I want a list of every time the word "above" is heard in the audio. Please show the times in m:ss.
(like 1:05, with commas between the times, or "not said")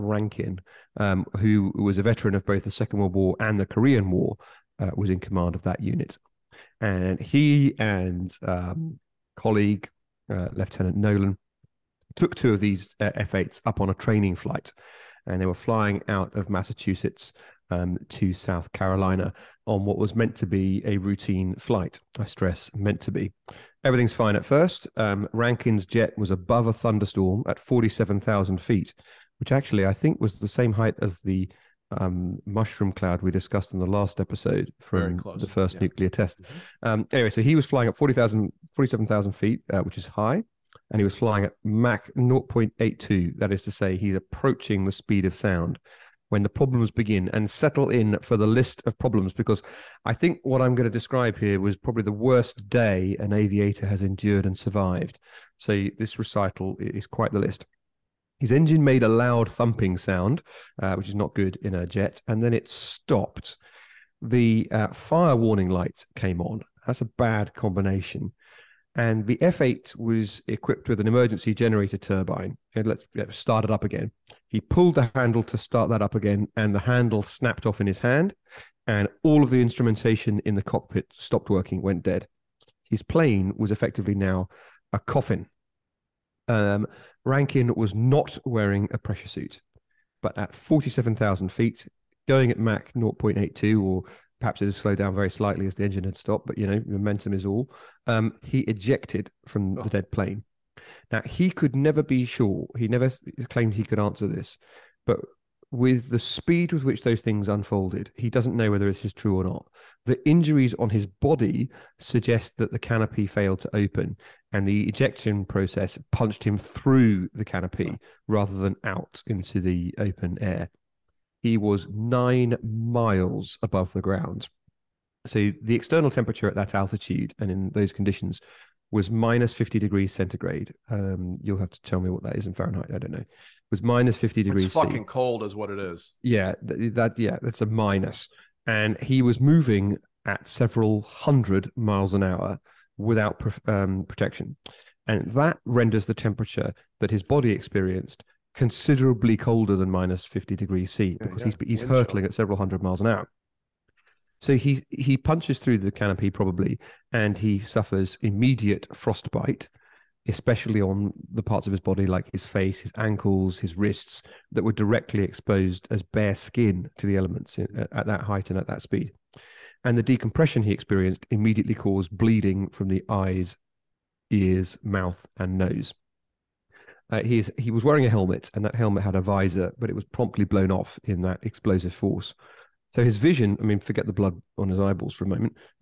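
0:26, 2:03.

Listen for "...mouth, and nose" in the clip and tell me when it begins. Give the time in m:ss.
2:54.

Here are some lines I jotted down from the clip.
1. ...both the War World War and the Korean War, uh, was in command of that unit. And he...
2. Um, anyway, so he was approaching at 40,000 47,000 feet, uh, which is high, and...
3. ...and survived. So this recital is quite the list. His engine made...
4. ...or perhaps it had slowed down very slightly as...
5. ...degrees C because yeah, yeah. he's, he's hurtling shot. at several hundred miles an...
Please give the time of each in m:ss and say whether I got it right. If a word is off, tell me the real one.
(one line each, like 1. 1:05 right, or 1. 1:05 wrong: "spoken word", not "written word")
1. 0:02 wrong: "Second", not "War"
2. 0:36 wrong: "flying", not "approaching"
3. 0:54 right
4. 1:33 right
5. 2:30 right.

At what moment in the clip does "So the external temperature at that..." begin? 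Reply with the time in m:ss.
2:05.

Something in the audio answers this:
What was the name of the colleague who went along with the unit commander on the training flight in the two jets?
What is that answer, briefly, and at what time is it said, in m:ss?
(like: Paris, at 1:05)
Lieutenant Nolan, at 0:10.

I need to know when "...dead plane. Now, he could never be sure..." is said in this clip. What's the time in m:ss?
1:39.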